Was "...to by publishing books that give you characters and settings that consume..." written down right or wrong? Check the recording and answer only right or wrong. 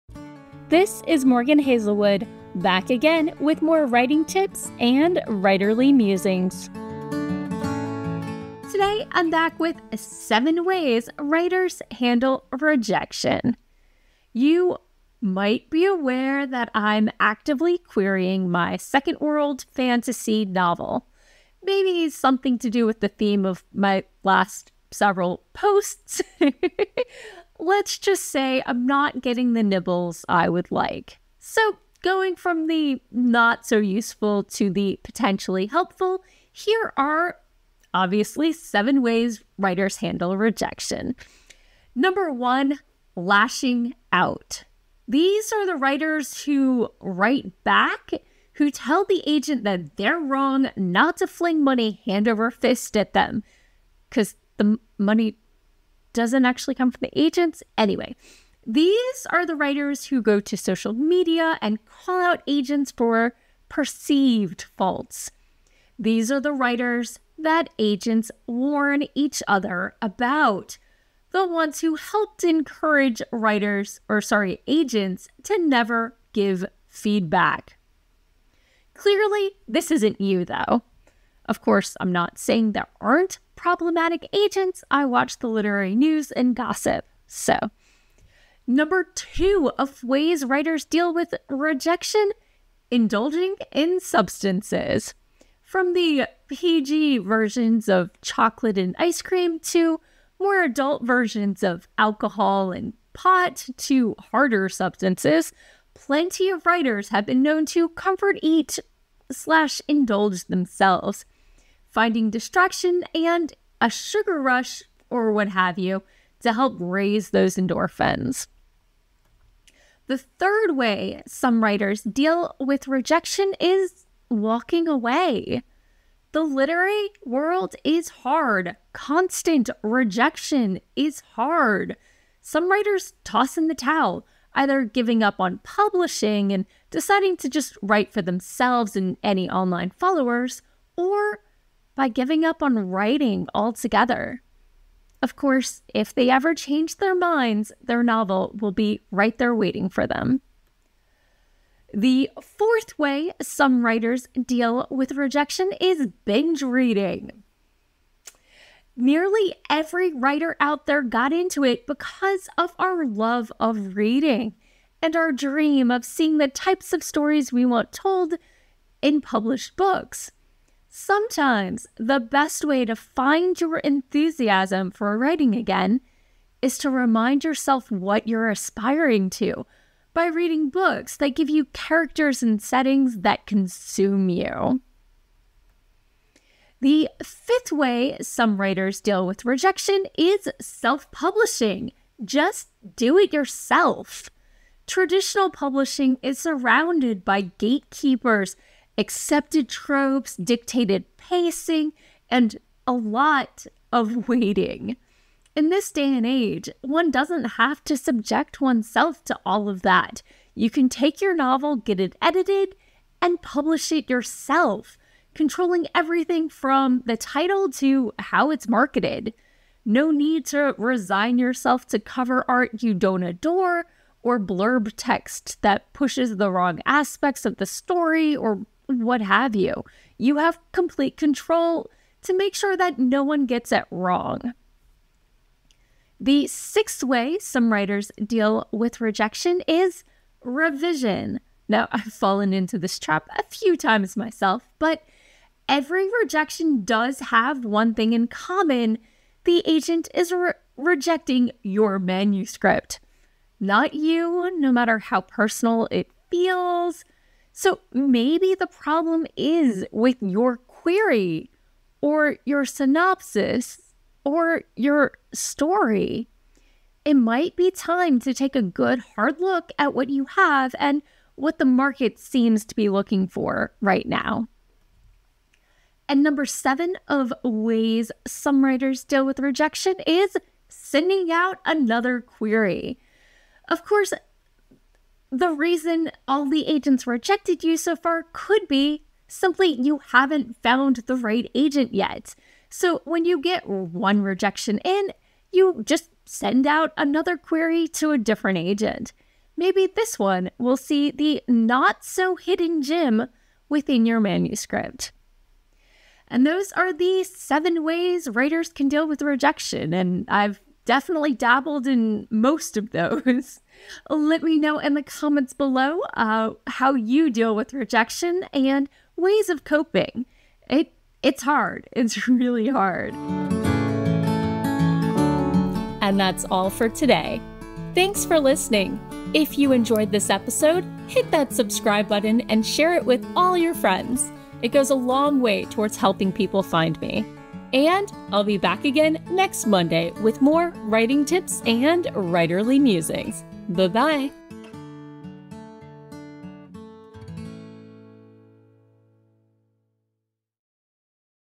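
wrong.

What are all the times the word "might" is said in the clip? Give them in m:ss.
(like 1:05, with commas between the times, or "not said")
0:15, 4:27.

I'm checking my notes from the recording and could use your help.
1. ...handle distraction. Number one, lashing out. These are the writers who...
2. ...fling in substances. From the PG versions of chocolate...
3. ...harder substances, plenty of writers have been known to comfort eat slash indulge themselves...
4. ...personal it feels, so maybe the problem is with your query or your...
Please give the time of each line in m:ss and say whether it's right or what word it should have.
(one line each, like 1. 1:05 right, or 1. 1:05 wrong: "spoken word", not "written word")
1. 0:39 wrong: "rejection", not "distraction"
2. 1:32 wrong: "indulging", not "fling"
3. 1:44 right
4. 4:15 right.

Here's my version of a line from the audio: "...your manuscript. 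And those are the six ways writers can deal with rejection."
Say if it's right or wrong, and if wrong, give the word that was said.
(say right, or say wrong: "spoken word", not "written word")
wrong: "seven", not "six".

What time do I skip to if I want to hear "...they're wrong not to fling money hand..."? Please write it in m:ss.
0:49.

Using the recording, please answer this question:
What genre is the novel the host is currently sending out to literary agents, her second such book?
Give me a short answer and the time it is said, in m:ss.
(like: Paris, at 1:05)
world fantasy, at 0:19.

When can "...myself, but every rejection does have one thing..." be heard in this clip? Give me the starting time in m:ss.
4:04.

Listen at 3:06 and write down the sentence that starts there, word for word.
The fifth way some writers deal with rejection is self publishing.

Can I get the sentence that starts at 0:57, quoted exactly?
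Anyway, these are the writers who go to social media and call out agents for perceived faults.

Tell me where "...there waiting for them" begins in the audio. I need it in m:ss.
2:29.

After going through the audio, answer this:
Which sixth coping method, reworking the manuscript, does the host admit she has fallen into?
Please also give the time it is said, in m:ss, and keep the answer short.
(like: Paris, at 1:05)
revision, at 4:00.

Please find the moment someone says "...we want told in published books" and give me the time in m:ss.
2:47.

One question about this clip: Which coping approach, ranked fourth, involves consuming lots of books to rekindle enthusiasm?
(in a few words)
binge reading.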